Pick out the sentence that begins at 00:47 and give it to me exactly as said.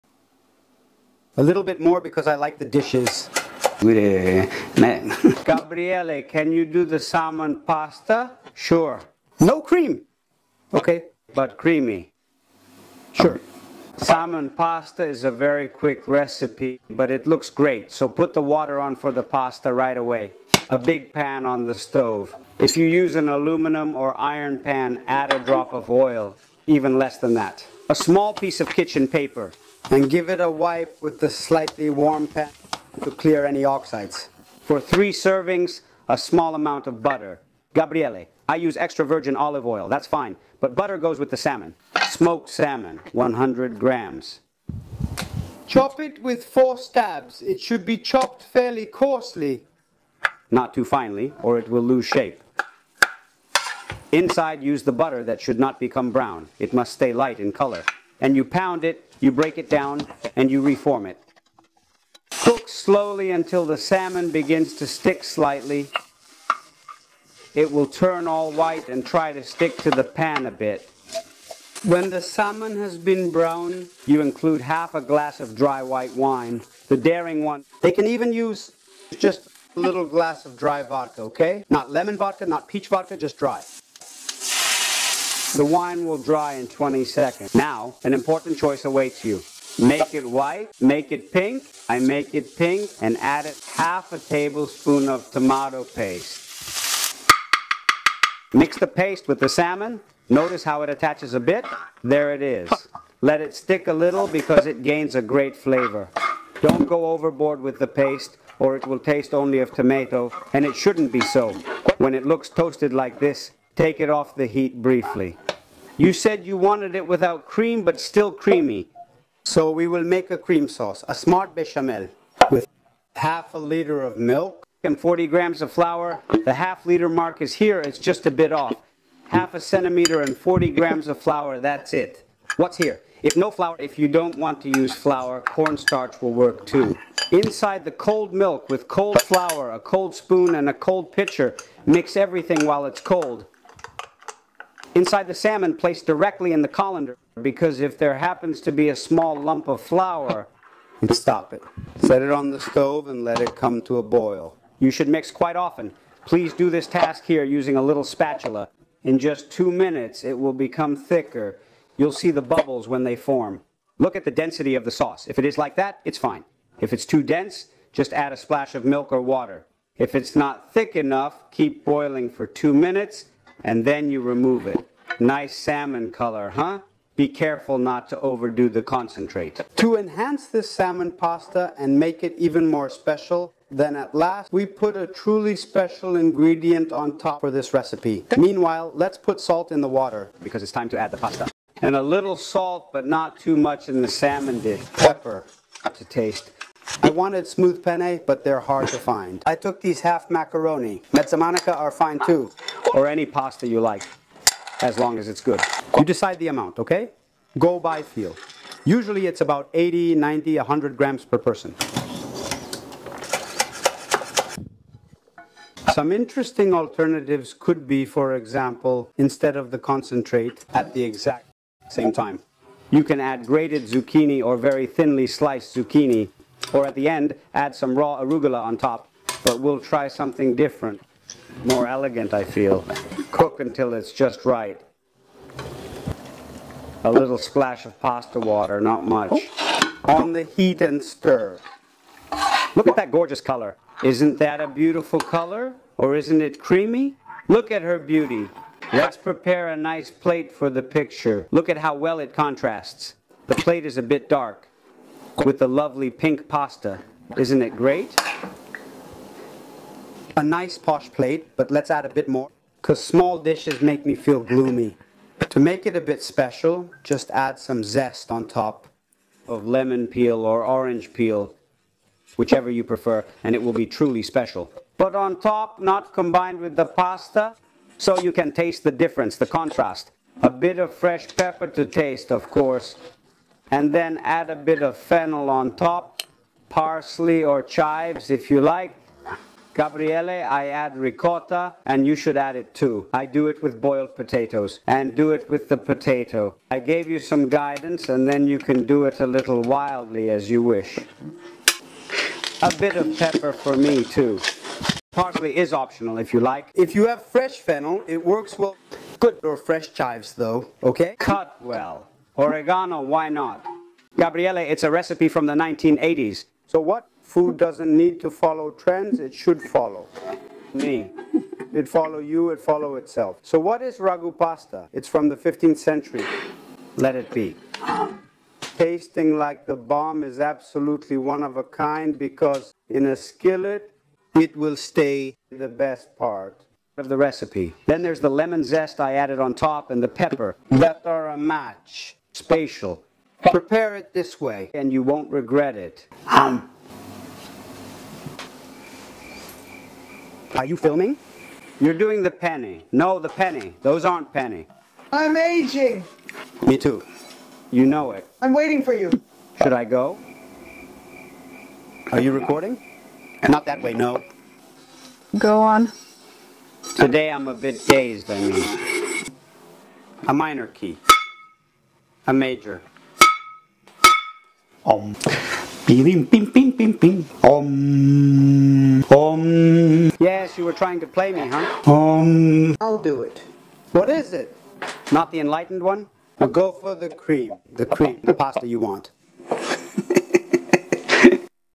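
It should be chopped fairly coarsely.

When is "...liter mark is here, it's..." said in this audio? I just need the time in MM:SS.
02:06.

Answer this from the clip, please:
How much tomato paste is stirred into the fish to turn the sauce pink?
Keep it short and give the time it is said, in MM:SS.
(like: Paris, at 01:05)
half a tablespoon, at 01:33.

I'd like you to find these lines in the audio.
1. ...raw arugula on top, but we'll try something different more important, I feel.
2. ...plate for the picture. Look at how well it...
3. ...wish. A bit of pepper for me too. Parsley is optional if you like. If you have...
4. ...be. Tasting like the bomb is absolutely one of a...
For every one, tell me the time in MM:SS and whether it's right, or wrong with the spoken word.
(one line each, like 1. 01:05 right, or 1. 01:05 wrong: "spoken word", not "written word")
1. 03:47 wrong: "elegant", not "important"
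2. 04:10 right
3. 05:00 right
4. 05:27 right.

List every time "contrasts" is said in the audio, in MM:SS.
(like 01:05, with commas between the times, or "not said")
04:12, 04:39.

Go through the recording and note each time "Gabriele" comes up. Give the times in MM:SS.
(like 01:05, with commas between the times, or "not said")
00:03, 00:37, 04:49, 05:14.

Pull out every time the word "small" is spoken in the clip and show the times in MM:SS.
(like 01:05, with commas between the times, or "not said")
00:27, 00:36, 02:28, 04:23.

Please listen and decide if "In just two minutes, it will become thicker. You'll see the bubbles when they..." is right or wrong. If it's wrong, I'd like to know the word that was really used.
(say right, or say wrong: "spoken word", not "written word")
right.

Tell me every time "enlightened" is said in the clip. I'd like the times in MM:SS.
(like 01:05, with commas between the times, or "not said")
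06:25.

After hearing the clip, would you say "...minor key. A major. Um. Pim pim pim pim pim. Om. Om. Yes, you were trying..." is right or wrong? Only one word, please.
right.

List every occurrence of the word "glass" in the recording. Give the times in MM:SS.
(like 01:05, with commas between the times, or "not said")
01:15, 01:20.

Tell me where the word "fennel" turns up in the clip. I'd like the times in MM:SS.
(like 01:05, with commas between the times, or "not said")
04:44, 05:07.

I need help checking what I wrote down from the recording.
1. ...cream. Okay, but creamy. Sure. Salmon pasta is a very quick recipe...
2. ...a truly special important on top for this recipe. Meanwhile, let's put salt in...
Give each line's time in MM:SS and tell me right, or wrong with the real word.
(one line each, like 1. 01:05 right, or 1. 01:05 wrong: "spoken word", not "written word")
1. 00:09 right
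2. 03:04 wrong: "ingredient", not "important".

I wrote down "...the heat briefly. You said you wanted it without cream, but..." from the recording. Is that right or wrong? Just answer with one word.
right.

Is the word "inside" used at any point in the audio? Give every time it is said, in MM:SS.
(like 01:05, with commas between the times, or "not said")
00:54, 02:17, 02:24.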